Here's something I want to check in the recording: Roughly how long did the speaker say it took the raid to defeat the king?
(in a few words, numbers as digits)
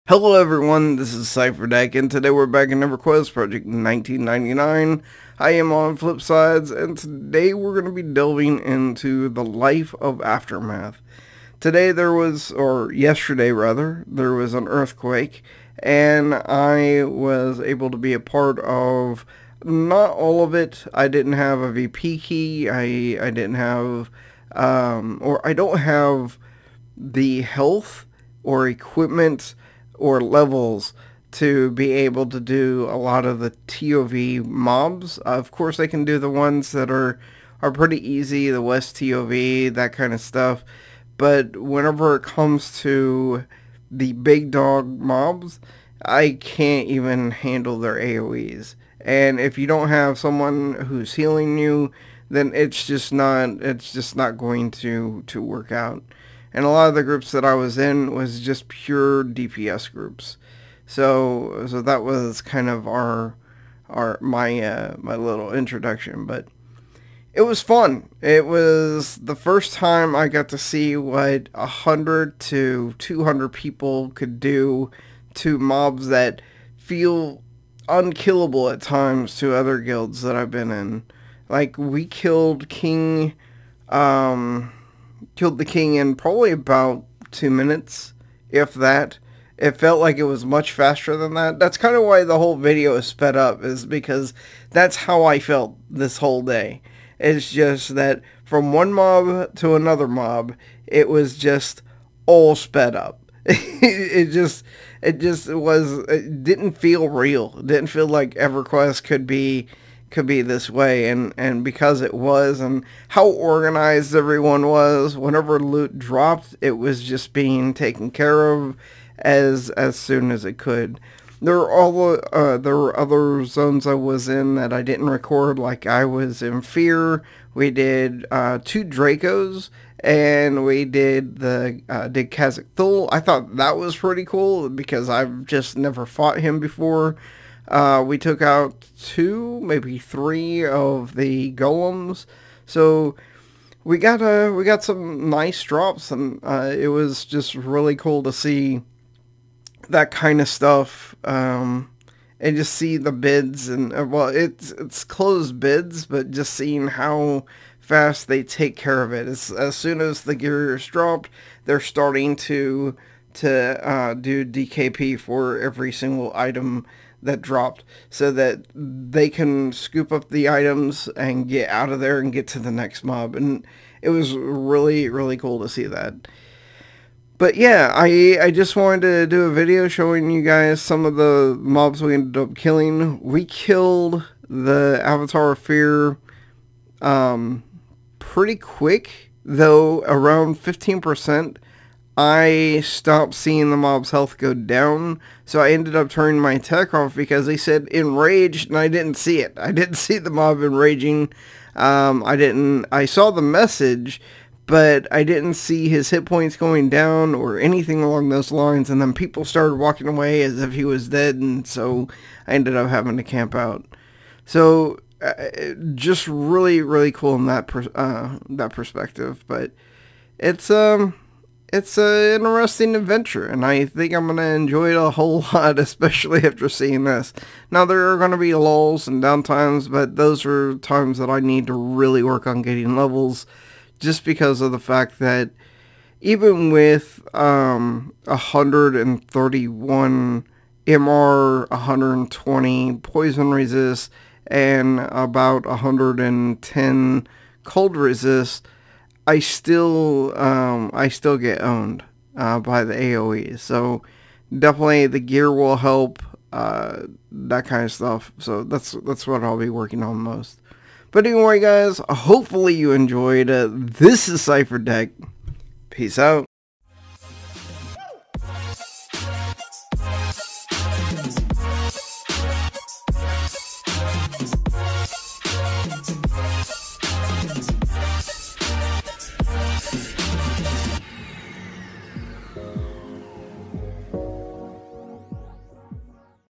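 2 minutes.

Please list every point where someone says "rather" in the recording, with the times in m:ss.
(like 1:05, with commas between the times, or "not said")
0:13.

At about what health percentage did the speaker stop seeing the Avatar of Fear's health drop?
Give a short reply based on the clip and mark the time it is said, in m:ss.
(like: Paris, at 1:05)
15%, at 3:10.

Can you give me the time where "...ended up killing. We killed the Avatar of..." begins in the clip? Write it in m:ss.
3:02.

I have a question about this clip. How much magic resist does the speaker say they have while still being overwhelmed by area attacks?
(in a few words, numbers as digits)
131.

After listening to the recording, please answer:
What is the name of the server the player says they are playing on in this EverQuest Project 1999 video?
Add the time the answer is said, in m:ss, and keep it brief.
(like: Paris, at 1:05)
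Flipsides, at 0:05.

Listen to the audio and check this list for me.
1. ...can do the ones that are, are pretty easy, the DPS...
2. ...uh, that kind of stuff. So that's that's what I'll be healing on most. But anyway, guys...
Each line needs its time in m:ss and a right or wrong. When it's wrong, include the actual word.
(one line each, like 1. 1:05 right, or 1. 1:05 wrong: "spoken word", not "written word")
1. 0:35 wrong: "West", not "DPS"
2. 4:16 wrong: "working", not "healing".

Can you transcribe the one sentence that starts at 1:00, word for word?
So so that was kind of our our my uh, my little introduction, but it was fun.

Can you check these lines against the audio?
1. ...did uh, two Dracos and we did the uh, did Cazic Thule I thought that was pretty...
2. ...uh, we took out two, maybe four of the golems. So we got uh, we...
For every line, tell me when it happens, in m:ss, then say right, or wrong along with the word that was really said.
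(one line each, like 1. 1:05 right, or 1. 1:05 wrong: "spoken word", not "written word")
1. 2:07 right
2. 2:17 wrong: "three", not "four".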